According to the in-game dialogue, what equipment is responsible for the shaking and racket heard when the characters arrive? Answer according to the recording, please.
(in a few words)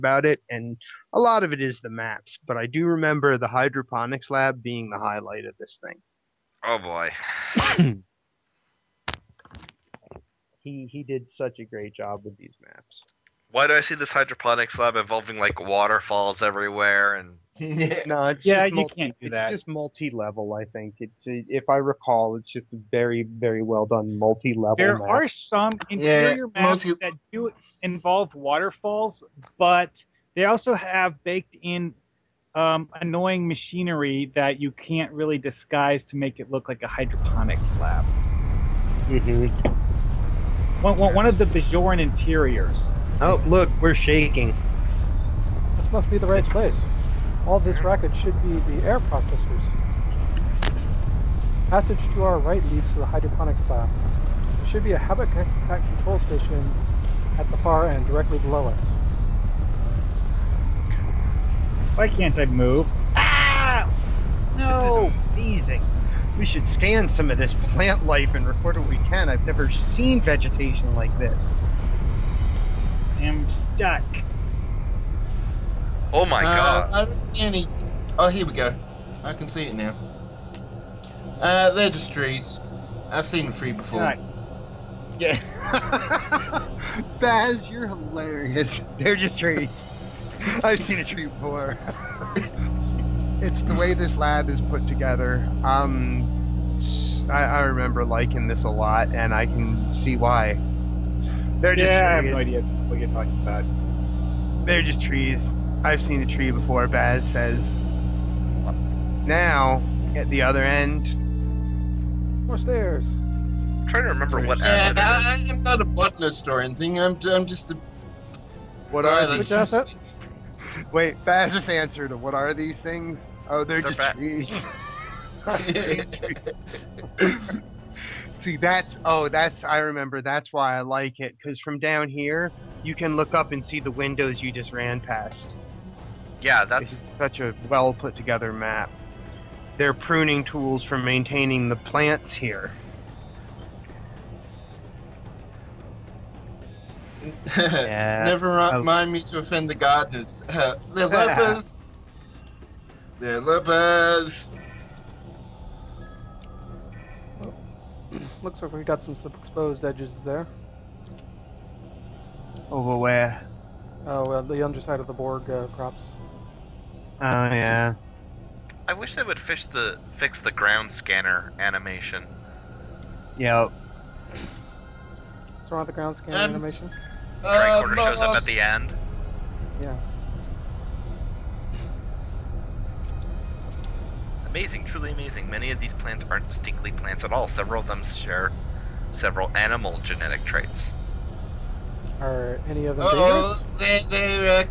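air processors.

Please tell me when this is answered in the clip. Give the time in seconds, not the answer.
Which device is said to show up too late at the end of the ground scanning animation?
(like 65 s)
177 s.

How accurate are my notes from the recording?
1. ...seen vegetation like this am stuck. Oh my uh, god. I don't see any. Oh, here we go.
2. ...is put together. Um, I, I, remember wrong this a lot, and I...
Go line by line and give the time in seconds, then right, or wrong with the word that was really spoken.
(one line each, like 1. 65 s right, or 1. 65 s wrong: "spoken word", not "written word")
1. 69 s right
2. 94 s wrong: "liking", not "wrong".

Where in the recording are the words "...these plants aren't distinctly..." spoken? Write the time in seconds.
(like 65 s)
185 s.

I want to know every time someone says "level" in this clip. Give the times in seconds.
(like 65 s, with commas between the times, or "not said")
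19 s, 24 s.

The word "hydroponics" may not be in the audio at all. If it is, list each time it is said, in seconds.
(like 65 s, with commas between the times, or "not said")
3 s, 14 s, 36 s, 53 s.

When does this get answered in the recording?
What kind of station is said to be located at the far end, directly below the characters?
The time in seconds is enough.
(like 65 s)
54 s.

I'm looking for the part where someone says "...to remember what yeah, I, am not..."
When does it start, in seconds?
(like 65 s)
114 s.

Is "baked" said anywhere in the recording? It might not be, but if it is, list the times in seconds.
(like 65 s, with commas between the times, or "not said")
31 s.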